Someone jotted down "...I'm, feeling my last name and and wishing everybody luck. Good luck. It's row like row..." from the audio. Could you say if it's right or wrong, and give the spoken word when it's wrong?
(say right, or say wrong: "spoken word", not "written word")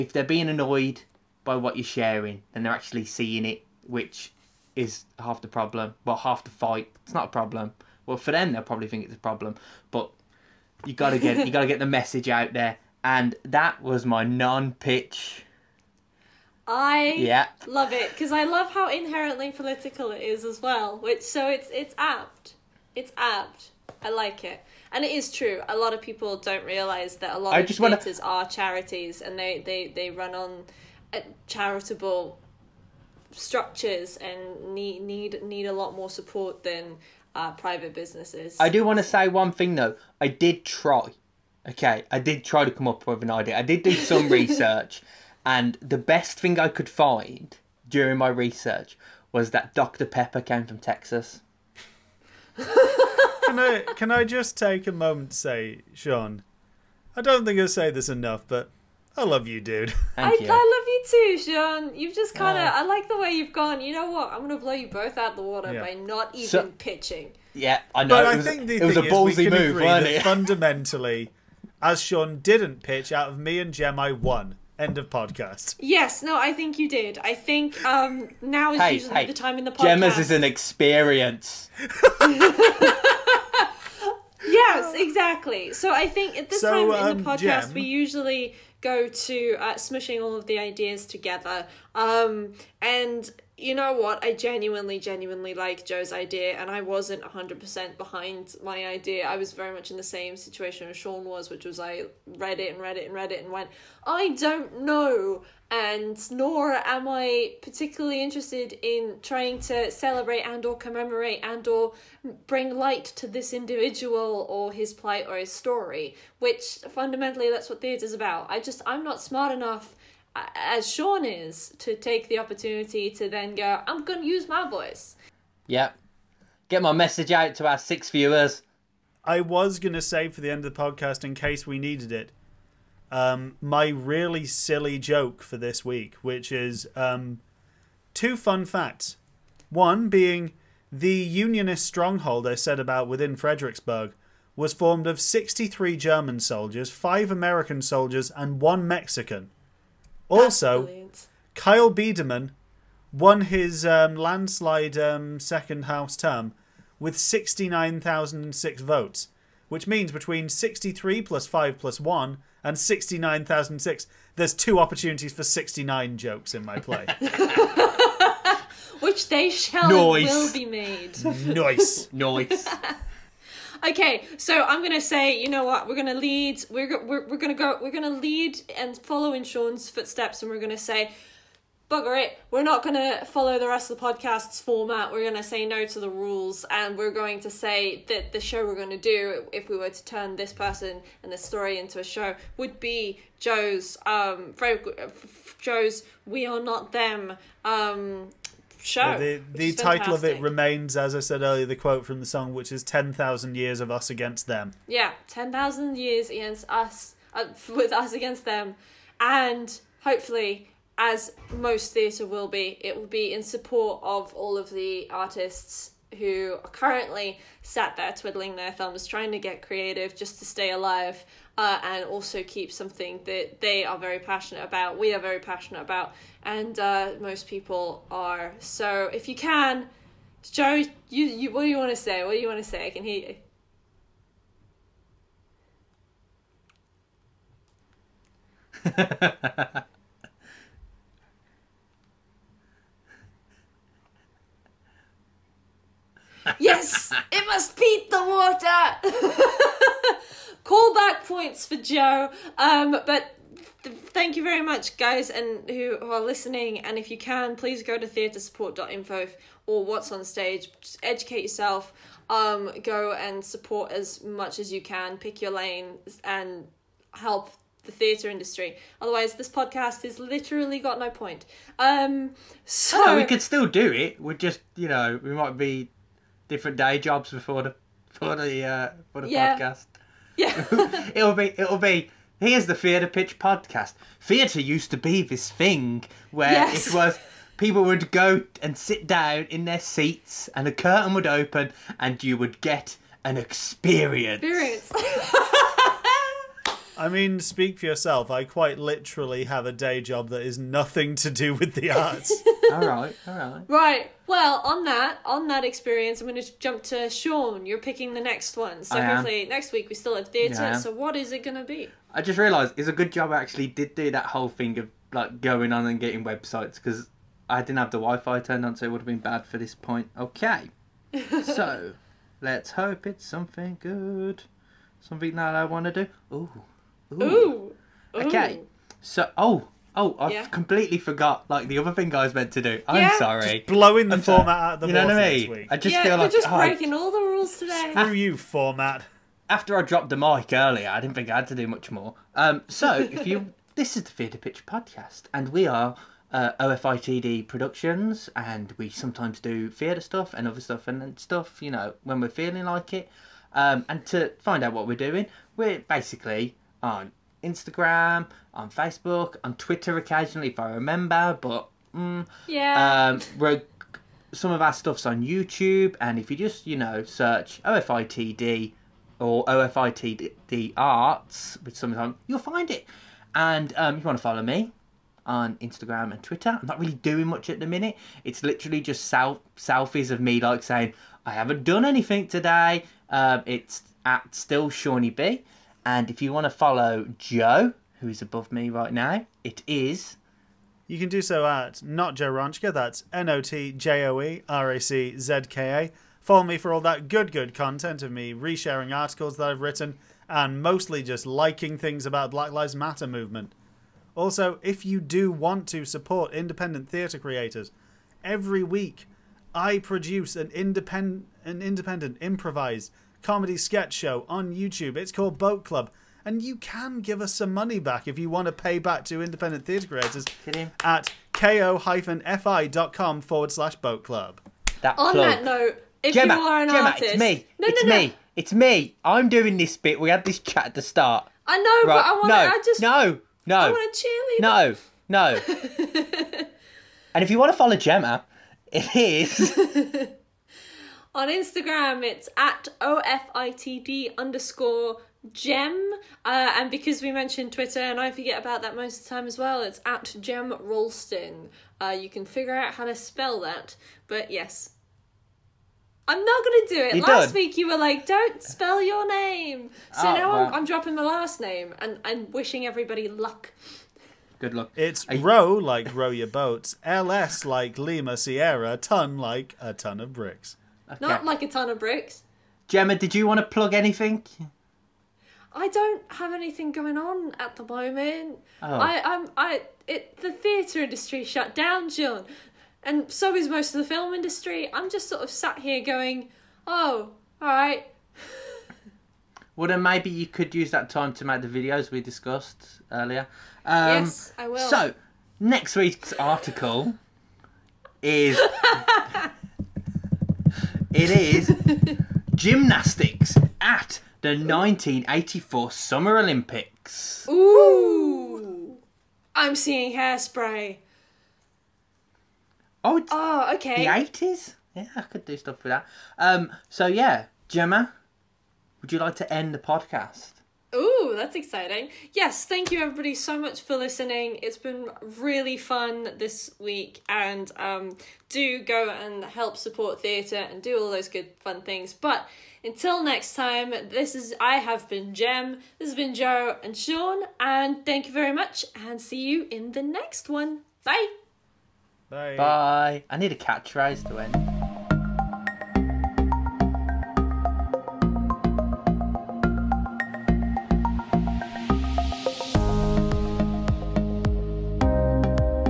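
wrong: "dropping", not "feeling".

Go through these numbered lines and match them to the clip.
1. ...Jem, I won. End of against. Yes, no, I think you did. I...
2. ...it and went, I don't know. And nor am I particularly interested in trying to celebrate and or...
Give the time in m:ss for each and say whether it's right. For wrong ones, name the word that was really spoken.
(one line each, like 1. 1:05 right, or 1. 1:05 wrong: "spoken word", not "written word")
1. 1:13 wrong: "podcast", not "against"
2. 1:43 right.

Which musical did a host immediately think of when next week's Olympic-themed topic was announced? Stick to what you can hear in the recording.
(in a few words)
Hairspray.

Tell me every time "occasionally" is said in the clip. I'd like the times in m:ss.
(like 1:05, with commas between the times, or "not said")
5:59.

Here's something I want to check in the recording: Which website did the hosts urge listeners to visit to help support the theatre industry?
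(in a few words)
theatresupport.info.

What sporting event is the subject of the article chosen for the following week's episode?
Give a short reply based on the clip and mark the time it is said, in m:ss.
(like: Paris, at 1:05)
Gymnastics at the 1984 Summer Olympics, at 8:22.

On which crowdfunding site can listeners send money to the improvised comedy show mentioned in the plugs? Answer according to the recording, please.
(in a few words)
ko-fi.com.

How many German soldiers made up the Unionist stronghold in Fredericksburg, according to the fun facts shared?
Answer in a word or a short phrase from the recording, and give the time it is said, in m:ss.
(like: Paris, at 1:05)
63, at 2:25.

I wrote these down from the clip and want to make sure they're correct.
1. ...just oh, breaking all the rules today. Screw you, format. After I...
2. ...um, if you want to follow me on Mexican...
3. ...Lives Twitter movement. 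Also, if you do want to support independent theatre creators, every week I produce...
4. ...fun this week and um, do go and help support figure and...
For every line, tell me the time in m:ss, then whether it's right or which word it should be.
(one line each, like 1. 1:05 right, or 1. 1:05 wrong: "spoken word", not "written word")
1. 5:36 right
2. 6:13 wrong: "Instagram", not "Mexican"
3. 6:42 wrong: "Matter", not "Twitter"
4. 8:45 wrong: "theatre", not "figure".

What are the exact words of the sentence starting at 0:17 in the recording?
love it because I love how inherently political it is as well.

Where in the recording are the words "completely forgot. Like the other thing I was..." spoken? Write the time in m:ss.
5:30.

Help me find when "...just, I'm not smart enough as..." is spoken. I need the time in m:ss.
1:58.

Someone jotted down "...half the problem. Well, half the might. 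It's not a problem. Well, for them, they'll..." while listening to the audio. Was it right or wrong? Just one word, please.
wrong.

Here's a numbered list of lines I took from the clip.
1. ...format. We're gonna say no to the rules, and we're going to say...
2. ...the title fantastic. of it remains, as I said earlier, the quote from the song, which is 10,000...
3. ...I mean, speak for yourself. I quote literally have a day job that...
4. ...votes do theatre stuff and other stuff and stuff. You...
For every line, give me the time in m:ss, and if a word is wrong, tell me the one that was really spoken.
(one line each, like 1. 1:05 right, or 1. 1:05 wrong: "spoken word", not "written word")
1. 3:04 right
2. 3:19 right
3. 4:56 wrong: "quite", not "quote"
4. 5:48 wrong: "sometimes", not "votes".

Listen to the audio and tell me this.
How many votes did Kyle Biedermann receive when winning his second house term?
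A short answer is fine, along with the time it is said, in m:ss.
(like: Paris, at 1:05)
69,006, at 2:37.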